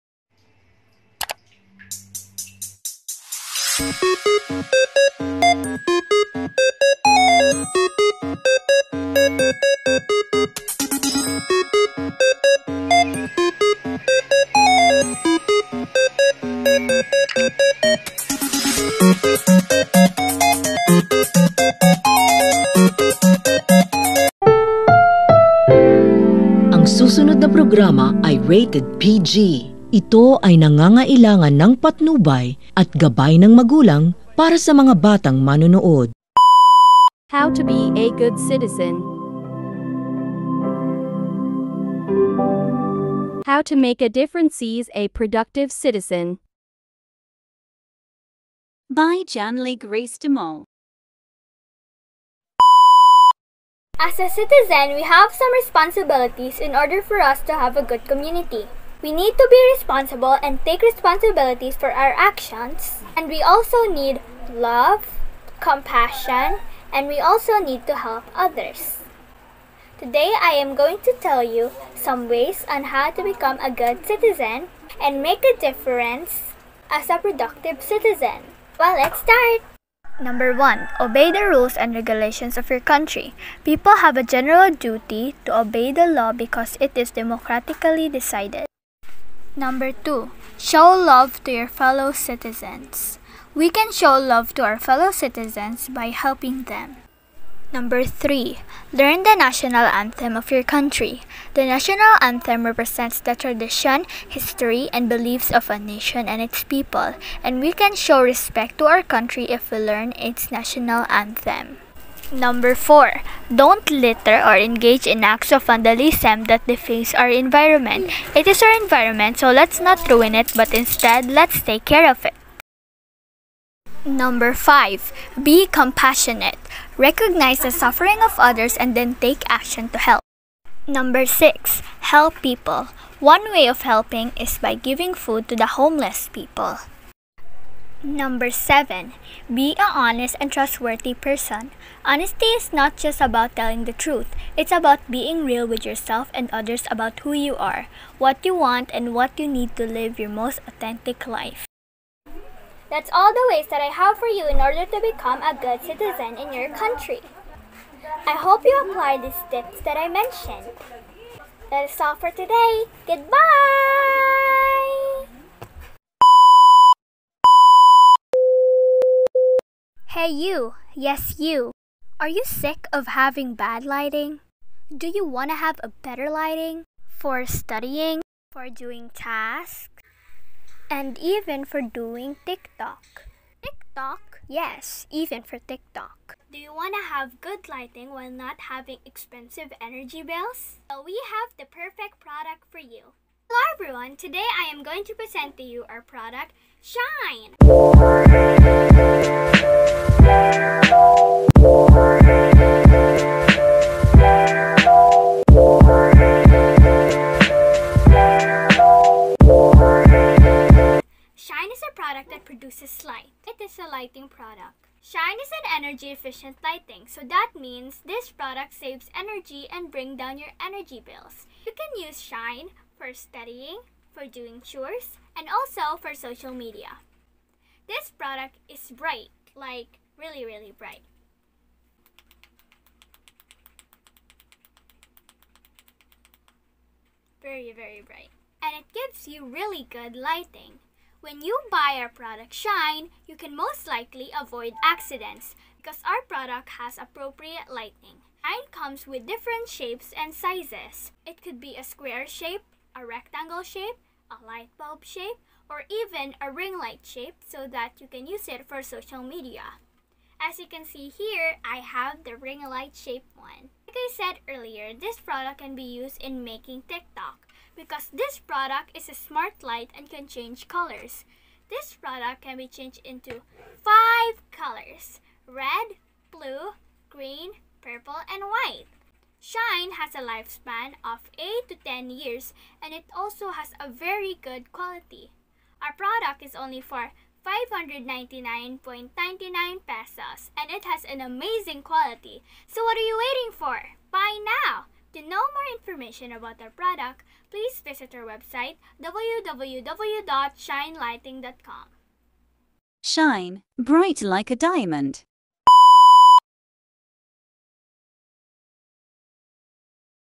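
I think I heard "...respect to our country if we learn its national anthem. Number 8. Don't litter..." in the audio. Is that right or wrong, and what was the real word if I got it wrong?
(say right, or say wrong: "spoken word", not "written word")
wrong: "4", not "8".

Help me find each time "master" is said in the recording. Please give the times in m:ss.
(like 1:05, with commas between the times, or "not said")
not said.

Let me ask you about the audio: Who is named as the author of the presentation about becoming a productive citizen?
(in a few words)
Janley Grace DeMol.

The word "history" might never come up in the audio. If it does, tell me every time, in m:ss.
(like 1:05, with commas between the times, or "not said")
1:44.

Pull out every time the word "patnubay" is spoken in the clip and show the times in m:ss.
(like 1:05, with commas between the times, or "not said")
0:31.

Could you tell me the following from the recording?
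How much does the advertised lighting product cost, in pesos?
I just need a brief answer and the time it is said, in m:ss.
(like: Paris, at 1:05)
599.99 pesos, at 4:47.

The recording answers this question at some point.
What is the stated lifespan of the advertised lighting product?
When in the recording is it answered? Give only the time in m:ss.
4:41.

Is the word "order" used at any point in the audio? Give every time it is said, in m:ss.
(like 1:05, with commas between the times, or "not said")
0:56, 2:34.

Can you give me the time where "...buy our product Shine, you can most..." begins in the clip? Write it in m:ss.
4:01.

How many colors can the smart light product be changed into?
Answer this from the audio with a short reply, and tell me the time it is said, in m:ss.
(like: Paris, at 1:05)
5, at 4:33.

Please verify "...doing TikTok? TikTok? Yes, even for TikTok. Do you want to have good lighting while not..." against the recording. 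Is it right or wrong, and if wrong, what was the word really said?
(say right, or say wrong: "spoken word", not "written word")
right.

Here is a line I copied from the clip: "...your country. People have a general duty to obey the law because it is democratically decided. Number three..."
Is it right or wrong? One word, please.
wrong.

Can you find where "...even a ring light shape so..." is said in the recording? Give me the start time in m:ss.
4:15.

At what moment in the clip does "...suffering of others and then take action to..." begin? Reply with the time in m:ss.
2:07.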